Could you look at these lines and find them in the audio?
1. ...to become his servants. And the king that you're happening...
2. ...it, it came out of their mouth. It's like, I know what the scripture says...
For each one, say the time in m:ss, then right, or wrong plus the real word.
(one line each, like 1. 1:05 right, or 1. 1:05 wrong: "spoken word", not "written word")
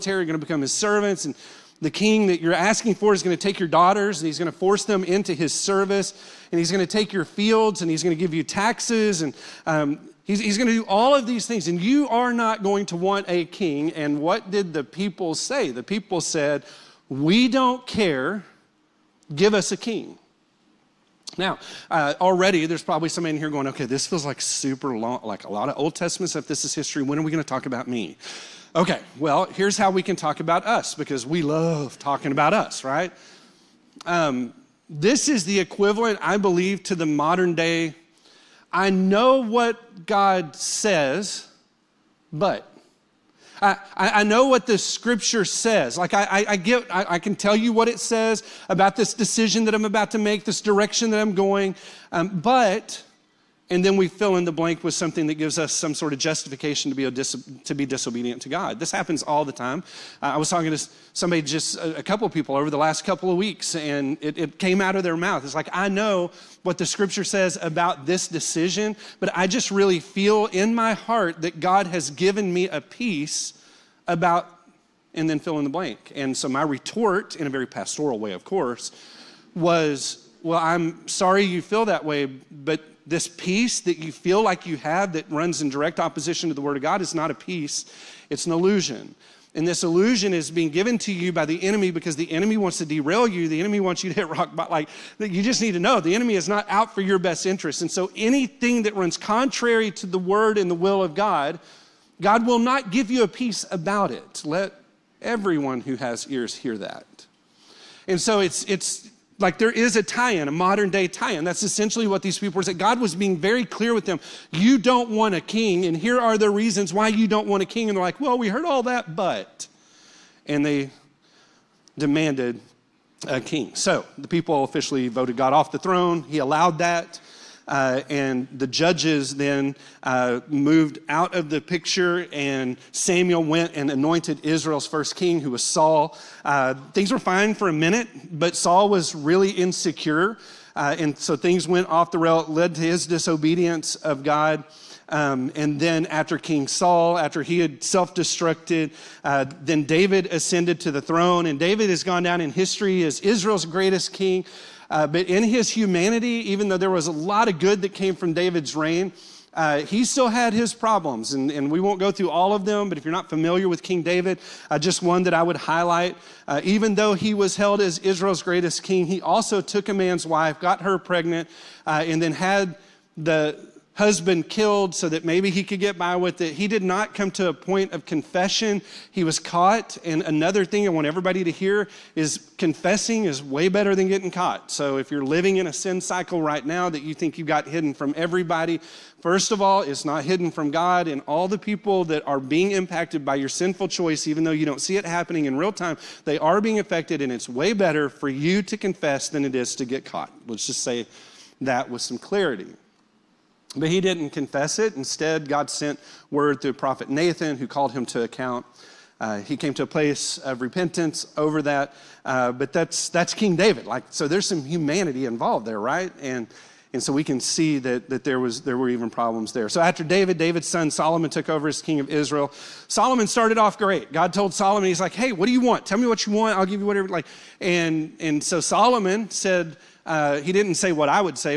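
1. 0:00 wrong: "asking", not "happening"
2. 1:04 right.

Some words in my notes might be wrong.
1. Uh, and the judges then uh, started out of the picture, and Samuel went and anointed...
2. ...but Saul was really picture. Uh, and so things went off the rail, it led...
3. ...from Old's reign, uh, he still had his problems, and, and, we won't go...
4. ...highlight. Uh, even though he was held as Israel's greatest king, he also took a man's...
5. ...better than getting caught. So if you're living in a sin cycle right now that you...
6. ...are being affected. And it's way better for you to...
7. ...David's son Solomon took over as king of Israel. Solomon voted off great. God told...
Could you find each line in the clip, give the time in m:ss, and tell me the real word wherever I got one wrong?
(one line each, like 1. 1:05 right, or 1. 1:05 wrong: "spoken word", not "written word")
1. 2:07 wrong: "moved", not "started"
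2. 2:18 wrong: "insecure", not "picture"
3. 2:38 wrong: "David", not "Old"
4. 2:45 right
5. 3:03 right
6. 3:16 right
7. 3:40 wrong: "started", not "voted".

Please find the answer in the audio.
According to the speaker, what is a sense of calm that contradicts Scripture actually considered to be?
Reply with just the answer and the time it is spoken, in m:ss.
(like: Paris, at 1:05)
An illusion, at 1:28.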